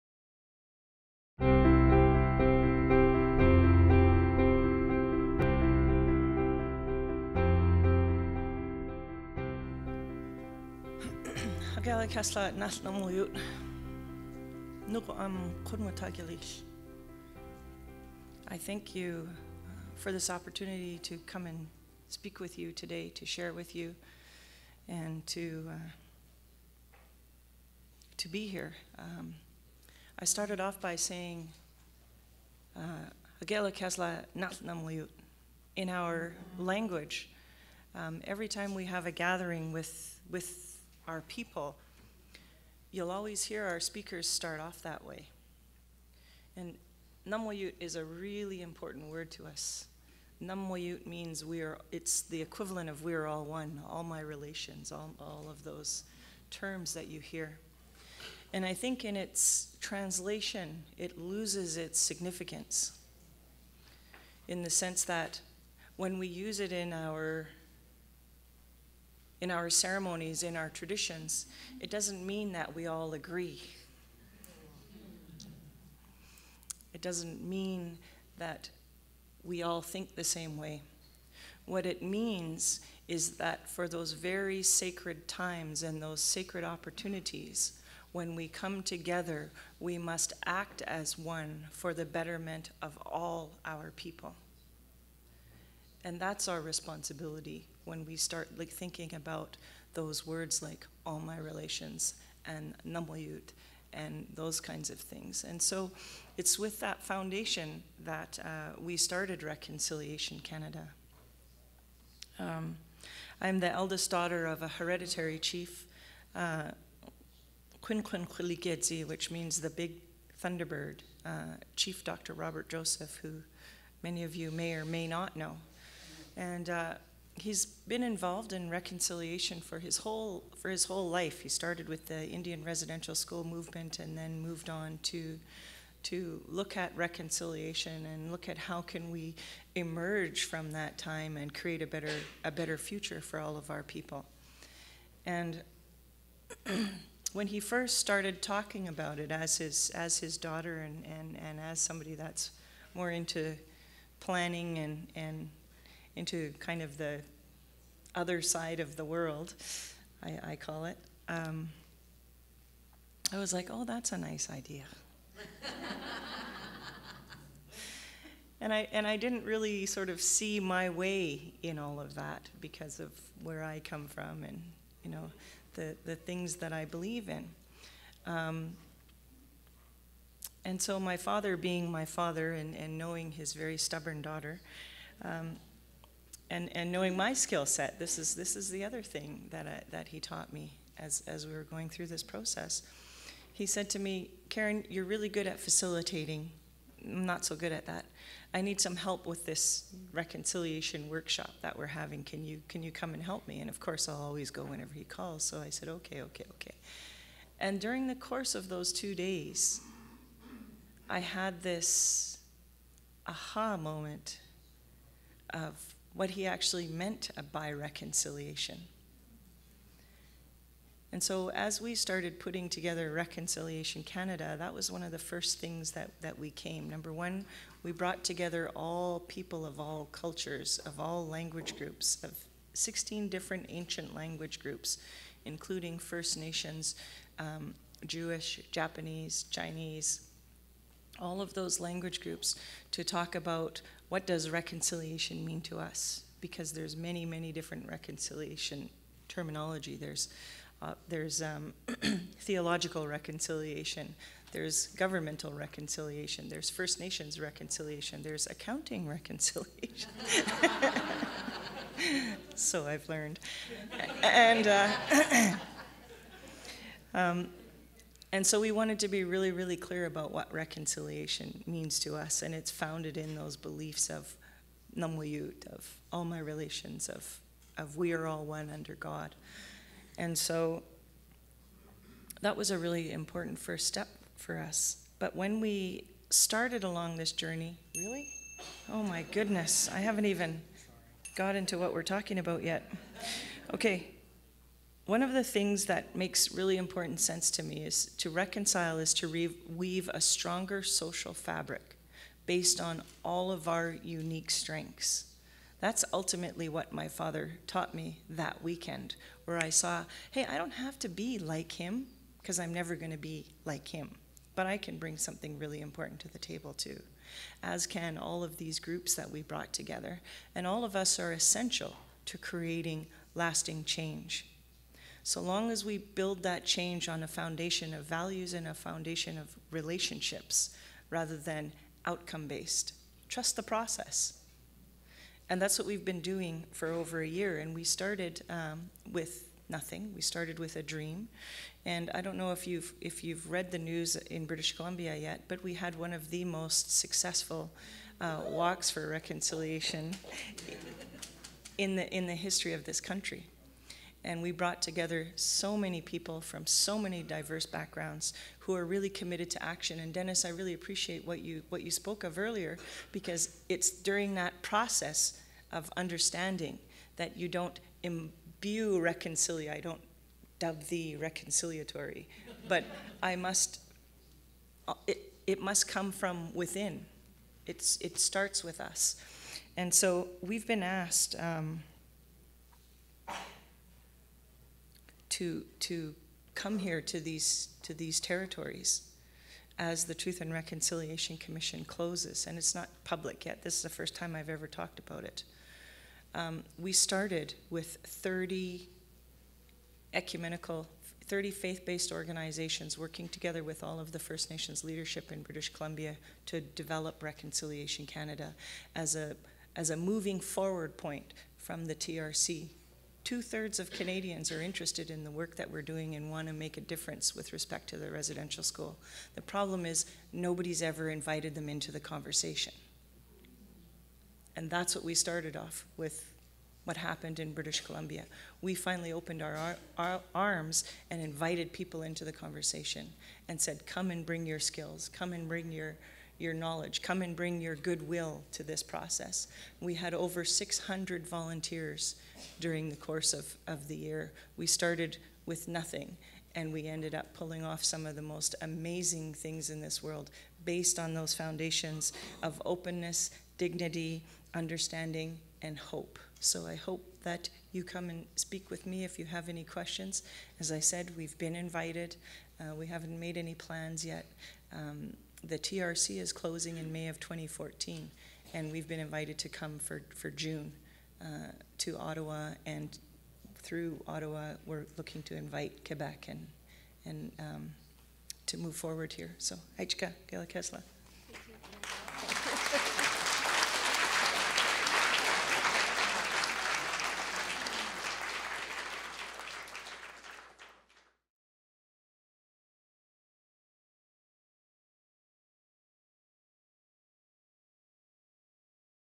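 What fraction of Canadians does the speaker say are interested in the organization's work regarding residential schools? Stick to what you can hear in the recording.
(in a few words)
Two-thirds.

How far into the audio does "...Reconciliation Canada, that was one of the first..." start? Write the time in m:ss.
3:43.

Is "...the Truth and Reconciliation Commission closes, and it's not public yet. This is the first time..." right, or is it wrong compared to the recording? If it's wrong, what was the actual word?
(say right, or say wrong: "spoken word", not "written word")
right.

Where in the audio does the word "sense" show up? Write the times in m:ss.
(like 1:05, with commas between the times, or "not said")
1:04, 4:57.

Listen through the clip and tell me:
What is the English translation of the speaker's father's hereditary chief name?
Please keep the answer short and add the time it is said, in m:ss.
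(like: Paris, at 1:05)
The big thunderbird, at 1:59.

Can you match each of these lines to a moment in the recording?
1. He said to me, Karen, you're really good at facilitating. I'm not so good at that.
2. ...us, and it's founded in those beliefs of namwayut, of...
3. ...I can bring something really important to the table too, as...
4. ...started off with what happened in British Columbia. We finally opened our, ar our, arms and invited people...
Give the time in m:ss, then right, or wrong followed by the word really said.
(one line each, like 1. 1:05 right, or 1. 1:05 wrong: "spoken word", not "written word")
1. 3:13 right
2. 4:32 right
3. 5:14 right
4. 7:05 right.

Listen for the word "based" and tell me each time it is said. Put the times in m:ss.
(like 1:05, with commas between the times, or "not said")
5:02, 5:32, 6:41, 7:30.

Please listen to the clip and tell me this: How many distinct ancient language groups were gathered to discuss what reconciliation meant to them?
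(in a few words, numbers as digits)
16.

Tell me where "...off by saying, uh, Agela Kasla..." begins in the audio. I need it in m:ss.
0:30.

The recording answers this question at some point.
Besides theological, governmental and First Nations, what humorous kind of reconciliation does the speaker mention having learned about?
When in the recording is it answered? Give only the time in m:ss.
4:18.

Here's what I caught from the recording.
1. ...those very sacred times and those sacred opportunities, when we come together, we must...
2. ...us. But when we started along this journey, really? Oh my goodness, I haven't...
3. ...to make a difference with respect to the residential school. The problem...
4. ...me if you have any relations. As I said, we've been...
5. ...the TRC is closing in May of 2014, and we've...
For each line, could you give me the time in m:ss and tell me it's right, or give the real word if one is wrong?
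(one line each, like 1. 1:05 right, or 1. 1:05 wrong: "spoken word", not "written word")
1. 1:23 right
2. 4:44 right
3. 6:56 right
4. 7:38 wrong: "questions", not "relations"
5. 7:45 right.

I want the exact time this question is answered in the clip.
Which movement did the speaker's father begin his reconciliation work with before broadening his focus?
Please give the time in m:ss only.
2:12.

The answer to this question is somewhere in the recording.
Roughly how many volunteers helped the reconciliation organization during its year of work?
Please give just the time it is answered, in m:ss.
7:20.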